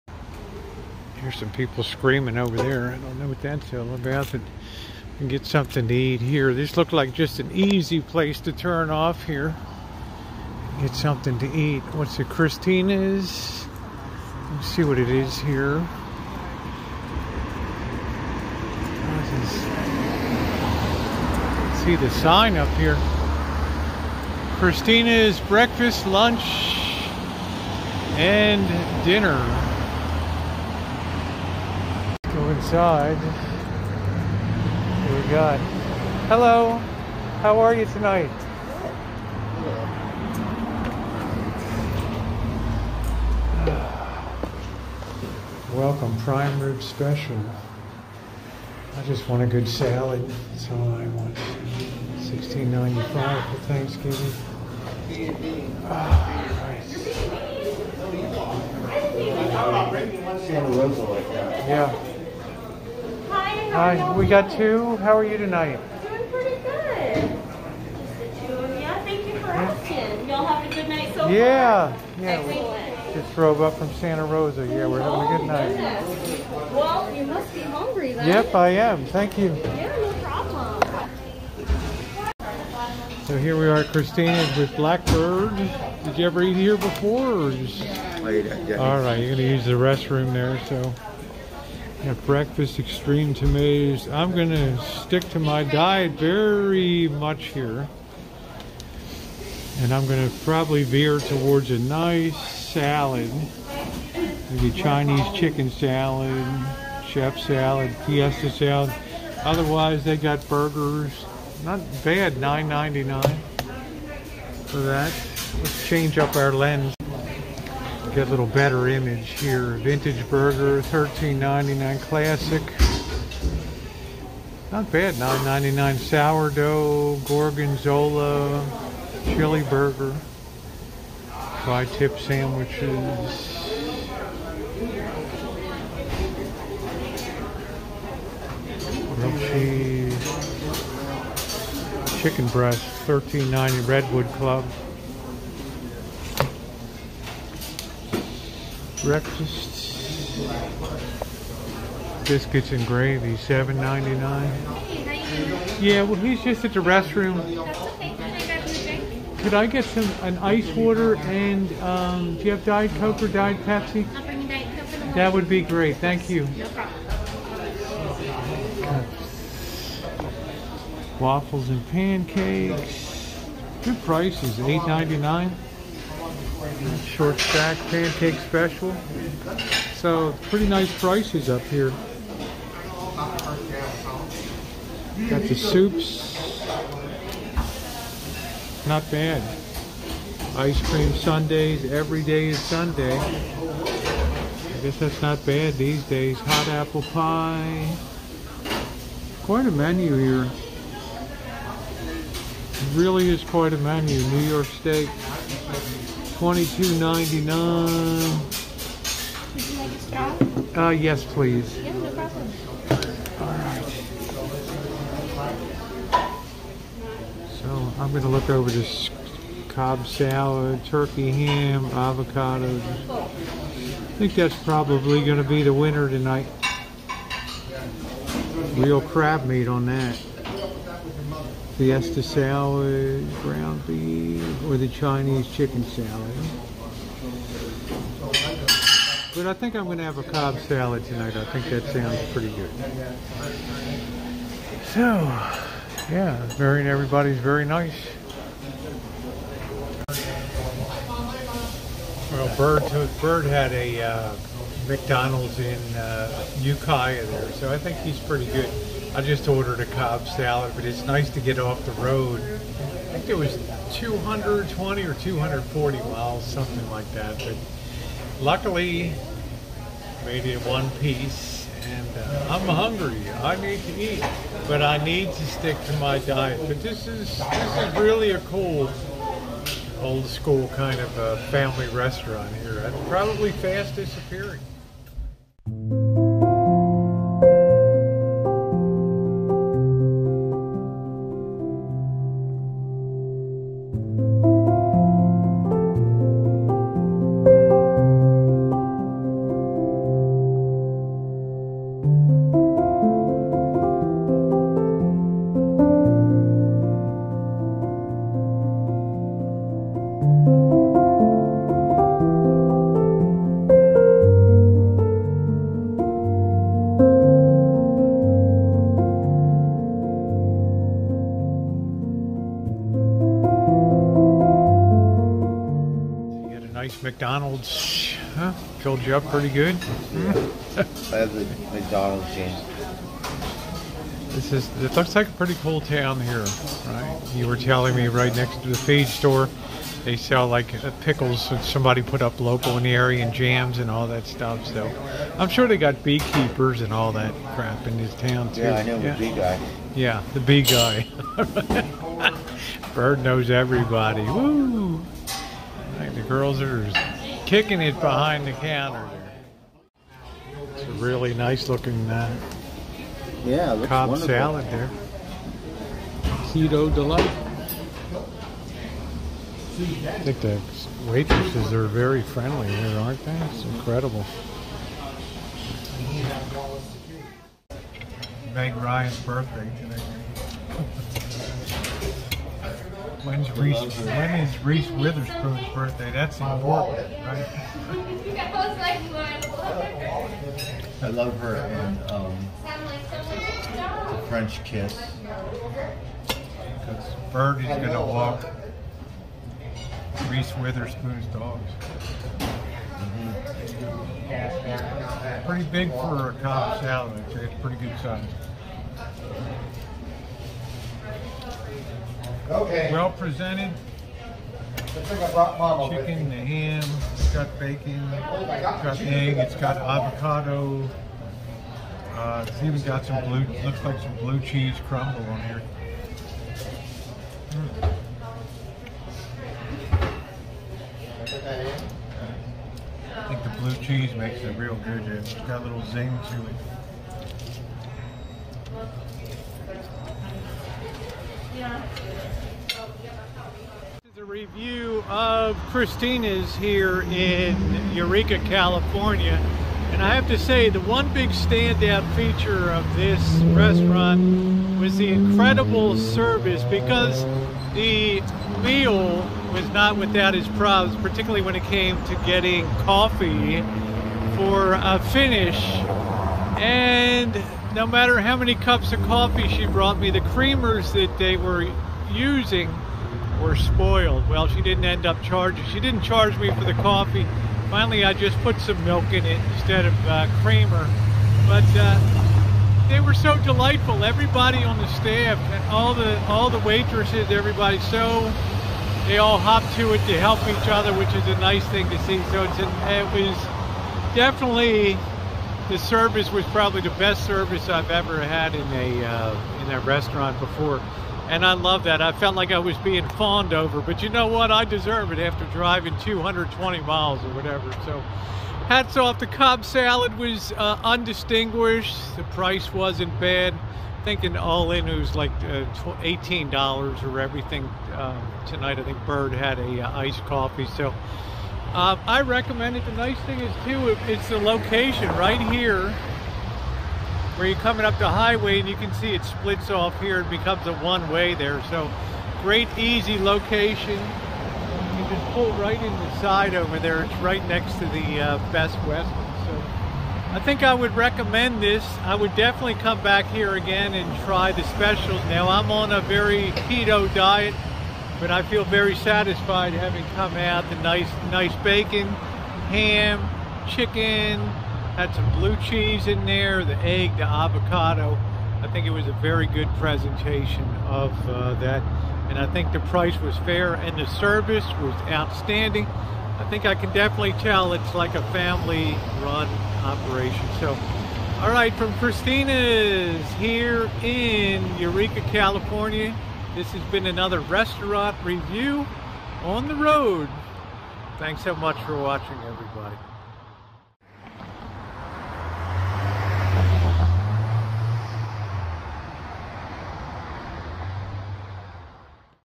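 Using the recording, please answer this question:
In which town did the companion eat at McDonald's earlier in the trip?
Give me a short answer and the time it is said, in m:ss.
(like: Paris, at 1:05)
Ukiah, at 4:16.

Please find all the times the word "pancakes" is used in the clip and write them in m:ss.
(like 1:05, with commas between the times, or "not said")
2:51, 2:57.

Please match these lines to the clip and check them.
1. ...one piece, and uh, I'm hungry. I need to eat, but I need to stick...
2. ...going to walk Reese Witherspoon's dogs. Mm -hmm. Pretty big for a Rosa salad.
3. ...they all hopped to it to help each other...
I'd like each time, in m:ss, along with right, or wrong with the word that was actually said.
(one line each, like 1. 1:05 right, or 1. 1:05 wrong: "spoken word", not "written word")
1. 4:30 right
2. 6:37 wrong: "Cobb", not "Rosa"
3. 8:09 right.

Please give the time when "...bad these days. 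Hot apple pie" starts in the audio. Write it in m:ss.
3:15.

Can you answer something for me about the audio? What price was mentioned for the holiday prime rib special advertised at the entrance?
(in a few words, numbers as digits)
$16.95.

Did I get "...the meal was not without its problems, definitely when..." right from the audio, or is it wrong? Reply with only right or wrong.
wrong.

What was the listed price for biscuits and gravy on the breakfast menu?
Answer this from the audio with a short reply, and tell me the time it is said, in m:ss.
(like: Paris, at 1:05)
$7.99, at 2:33.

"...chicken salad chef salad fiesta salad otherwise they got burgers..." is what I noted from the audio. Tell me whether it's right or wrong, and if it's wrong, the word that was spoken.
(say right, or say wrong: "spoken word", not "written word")
right.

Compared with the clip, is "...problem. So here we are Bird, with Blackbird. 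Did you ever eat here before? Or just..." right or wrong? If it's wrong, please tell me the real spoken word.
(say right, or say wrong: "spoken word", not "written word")
wrong: "Kristina", not "Bird".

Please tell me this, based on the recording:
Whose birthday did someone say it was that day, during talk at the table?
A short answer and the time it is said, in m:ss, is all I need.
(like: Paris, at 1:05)
Meg Ryan, at 6:18.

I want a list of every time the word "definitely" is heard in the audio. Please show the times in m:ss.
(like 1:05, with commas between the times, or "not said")
8:14, 9:02, 9:26.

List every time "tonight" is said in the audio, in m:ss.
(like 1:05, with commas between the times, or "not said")
0:37, 1:05, 3:46, 4:01, 8:38.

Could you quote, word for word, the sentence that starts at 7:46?
And no matter how many cups of coffee she brought me, the creamers that they were using were spoiled.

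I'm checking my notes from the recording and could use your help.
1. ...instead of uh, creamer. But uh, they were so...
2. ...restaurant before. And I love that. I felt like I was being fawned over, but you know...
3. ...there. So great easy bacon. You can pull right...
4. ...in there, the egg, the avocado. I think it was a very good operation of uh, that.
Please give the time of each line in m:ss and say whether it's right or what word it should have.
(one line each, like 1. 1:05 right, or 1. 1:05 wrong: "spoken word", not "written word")
1. 7:59 right
2. 8:19 right
3. 8:51 wrong: "location", not "bacon"
4. 9:16 wrong: "presentation", not "operation".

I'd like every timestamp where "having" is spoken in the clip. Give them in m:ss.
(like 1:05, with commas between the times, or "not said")
1:14, 9:09.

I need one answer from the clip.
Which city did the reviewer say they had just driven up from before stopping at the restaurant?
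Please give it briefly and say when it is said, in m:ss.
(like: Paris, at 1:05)
Santa Rosa, at 1:13.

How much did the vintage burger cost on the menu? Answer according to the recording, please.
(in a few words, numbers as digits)
$13.99.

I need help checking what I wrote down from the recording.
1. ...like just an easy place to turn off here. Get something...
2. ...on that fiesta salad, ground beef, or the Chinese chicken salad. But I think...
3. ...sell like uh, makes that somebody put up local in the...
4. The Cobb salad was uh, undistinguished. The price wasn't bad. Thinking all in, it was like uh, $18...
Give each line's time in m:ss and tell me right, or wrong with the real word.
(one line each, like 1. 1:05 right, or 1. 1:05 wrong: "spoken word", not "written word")
1. 0:06 right
2. 3:49 right
3. 5:40 wrong: "pickles", not "makes"
4. 8:29 right.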